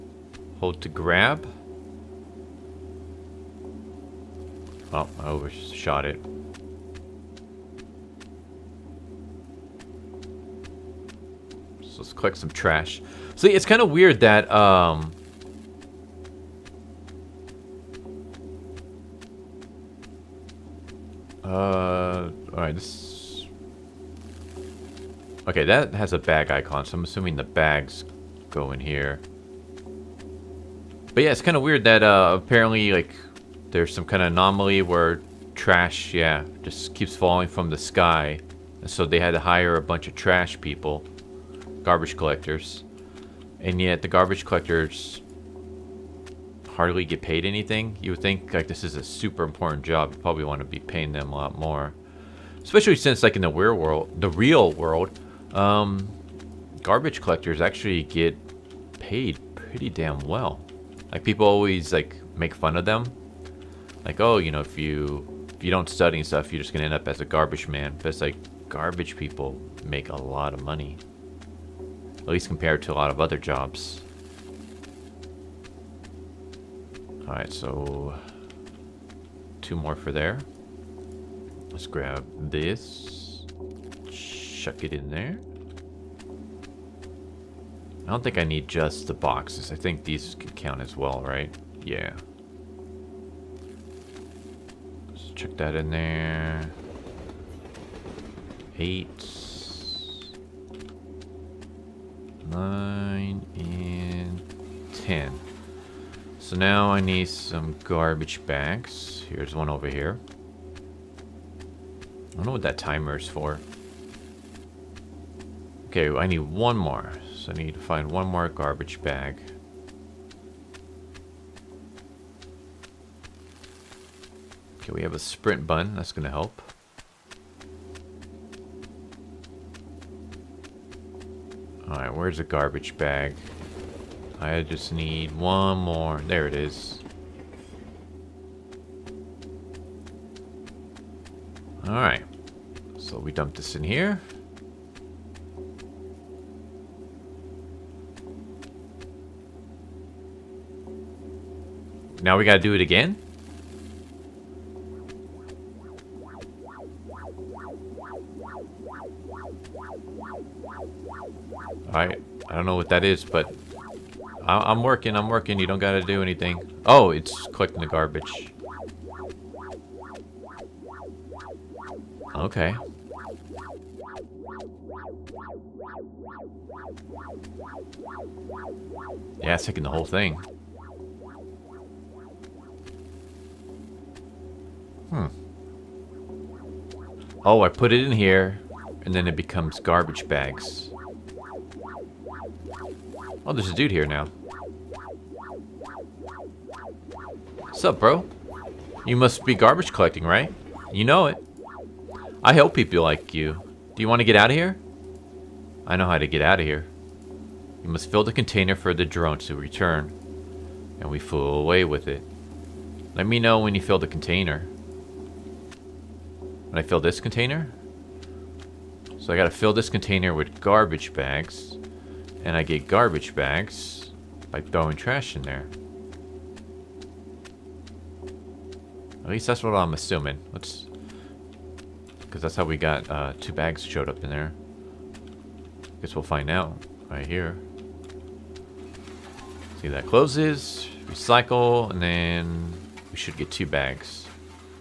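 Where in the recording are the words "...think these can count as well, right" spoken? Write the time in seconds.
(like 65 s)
89 s.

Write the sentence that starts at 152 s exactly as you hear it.
Now we gotta do it again?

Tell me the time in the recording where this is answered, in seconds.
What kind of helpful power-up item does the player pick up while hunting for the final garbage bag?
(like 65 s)
125 s.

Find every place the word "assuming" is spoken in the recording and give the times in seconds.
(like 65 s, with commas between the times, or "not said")
27 s, 229 s.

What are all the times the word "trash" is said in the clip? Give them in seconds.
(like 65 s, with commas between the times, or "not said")
12 s, 35 s, 40 s, 224 s.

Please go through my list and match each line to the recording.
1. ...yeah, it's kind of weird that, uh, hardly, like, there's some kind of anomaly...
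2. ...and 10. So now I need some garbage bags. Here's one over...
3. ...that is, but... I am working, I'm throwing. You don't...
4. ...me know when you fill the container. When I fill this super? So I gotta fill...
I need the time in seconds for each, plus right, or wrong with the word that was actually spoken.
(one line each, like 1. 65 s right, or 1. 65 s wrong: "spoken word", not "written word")
1. 31 s wrong: "apparently", not "hardly"
2. 103 s right
3. 162 s wrong: "working", not "throwing"
4. 213 s wrong: "container", not "super".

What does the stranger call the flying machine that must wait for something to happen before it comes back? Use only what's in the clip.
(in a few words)
Drone.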